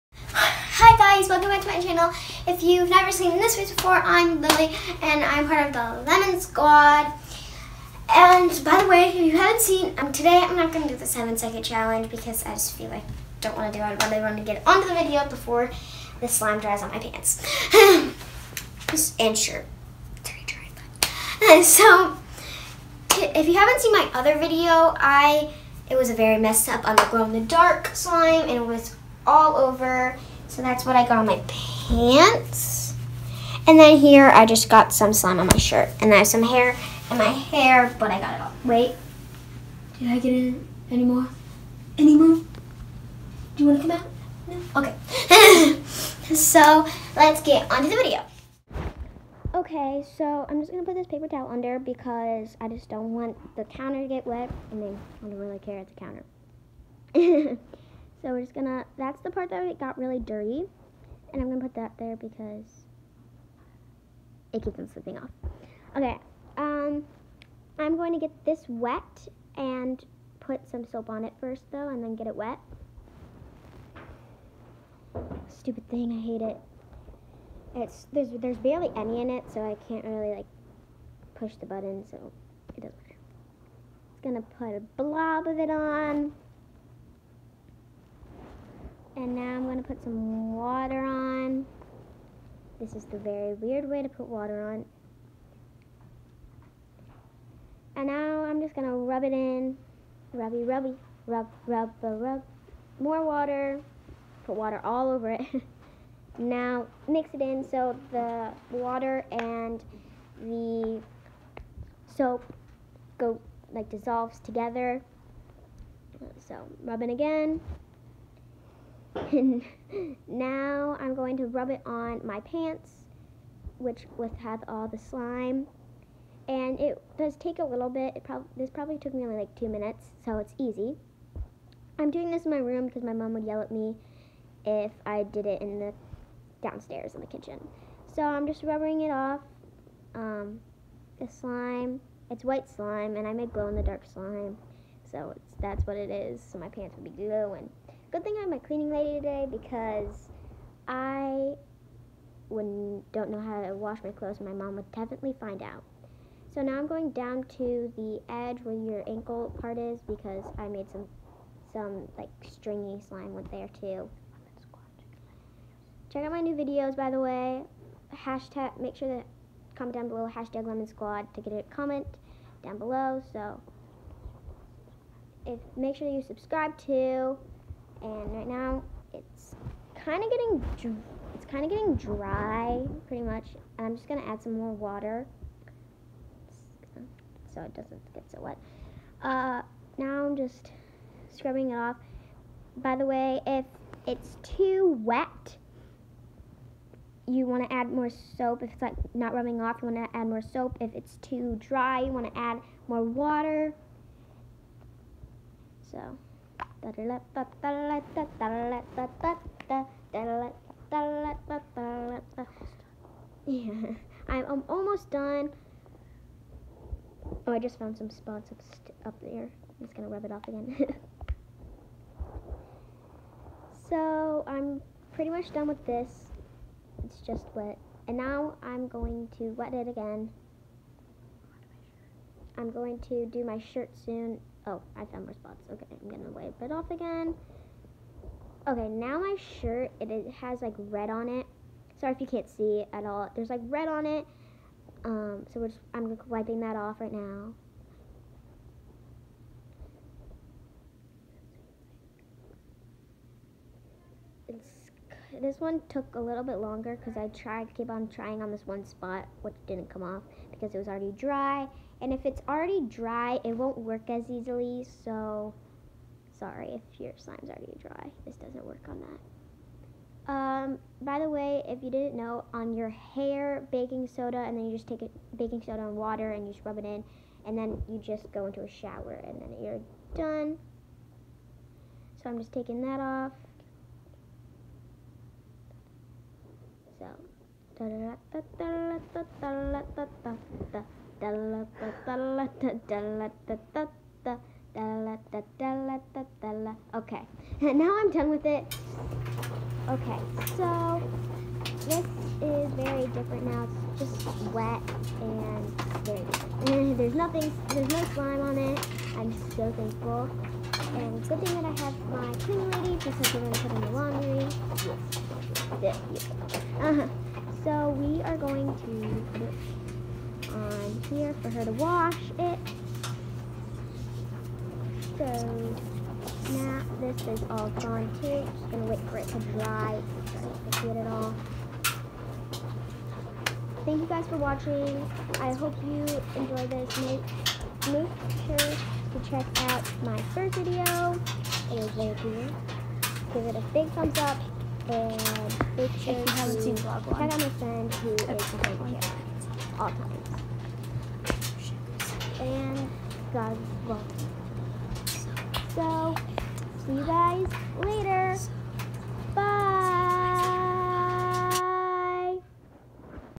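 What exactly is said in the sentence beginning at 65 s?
Okay, um, I'm going to get this wet and put some soap on it first though and then get it wet.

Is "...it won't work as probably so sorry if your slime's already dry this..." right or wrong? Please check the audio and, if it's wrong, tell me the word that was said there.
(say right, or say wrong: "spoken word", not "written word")
wrong: "easily", not "probably".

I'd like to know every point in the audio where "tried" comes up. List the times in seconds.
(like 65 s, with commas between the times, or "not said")
257 s.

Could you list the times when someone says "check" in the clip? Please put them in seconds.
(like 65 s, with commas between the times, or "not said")
166 s, 339 s, 347 s.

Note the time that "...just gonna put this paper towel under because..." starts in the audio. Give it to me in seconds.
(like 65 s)
50 s.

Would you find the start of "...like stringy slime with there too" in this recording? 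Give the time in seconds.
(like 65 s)
162 s.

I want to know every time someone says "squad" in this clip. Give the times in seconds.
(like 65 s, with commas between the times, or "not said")
6 s, 170 s.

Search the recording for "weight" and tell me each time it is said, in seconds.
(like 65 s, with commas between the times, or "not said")
not said.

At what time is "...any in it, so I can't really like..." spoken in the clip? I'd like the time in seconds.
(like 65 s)
78 s.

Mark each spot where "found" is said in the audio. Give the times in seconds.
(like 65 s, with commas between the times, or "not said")
217 s, 235 s.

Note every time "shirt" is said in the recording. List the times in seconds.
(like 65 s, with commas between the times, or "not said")
19 s, 35 s, 233 s, 239 s.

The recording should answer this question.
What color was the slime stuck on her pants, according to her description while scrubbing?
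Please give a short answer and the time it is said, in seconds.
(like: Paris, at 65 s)
white, at 142 s.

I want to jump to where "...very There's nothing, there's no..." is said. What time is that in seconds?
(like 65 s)
306 s.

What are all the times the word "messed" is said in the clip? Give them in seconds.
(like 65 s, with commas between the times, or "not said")
26 s.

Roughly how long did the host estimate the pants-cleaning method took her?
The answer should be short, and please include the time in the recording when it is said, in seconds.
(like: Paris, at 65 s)
2 minutes, at 129 s.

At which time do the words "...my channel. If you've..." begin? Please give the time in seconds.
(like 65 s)
1 s.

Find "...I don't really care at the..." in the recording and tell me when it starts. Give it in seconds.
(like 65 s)
55 s.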